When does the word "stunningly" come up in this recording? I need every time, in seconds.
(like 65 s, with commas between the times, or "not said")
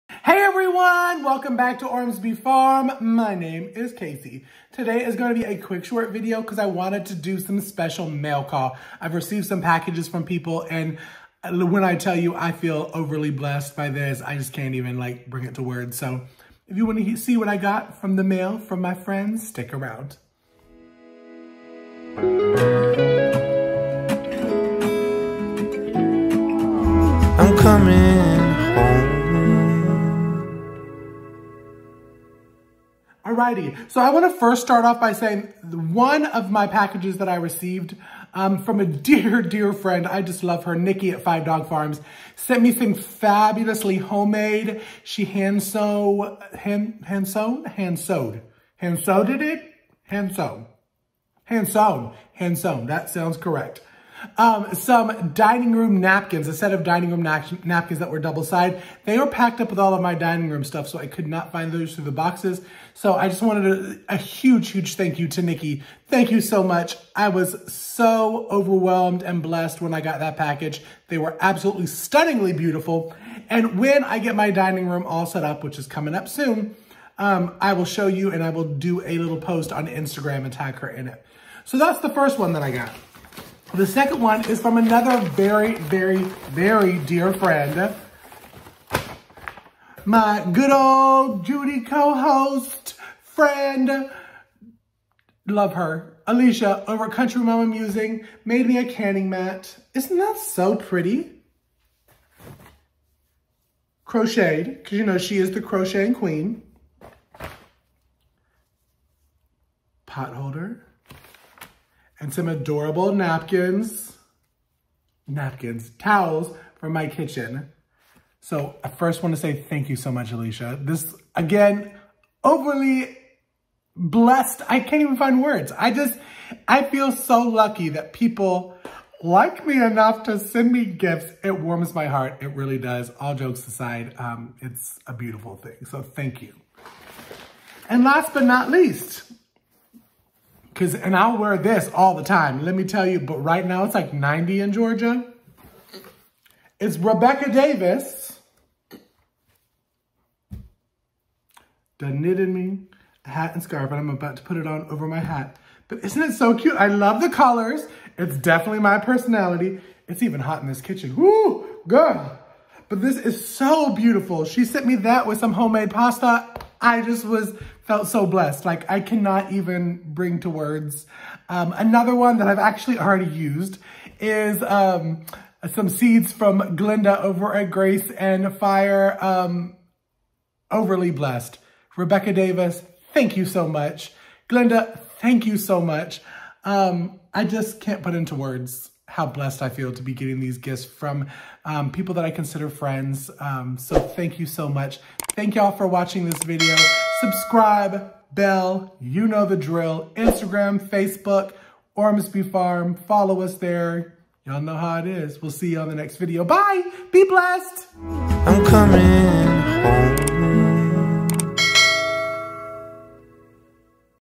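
71 s.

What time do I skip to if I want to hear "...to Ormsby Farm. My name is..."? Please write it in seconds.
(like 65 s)
1 s.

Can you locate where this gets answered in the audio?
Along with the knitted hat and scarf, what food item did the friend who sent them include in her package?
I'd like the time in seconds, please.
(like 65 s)
165 s.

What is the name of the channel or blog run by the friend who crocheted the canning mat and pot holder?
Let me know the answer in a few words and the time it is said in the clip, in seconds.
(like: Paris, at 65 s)
Country Mama Musing, at 97 s.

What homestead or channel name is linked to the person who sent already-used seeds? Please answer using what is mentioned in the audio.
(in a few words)
Grace and Fire.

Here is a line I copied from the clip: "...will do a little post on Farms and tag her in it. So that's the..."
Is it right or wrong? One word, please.
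wrong.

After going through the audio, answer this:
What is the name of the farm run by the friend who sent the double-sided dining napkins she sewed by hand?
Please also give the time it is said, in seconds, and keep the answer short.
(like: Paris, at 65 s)
Five Dog Farms, at 41 s.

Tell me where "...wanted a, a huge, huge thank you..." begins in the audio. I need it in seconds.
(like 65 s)
63 s.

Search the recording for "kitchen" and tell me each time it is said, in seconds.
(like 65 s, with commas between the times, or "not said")
117 s, 160 s.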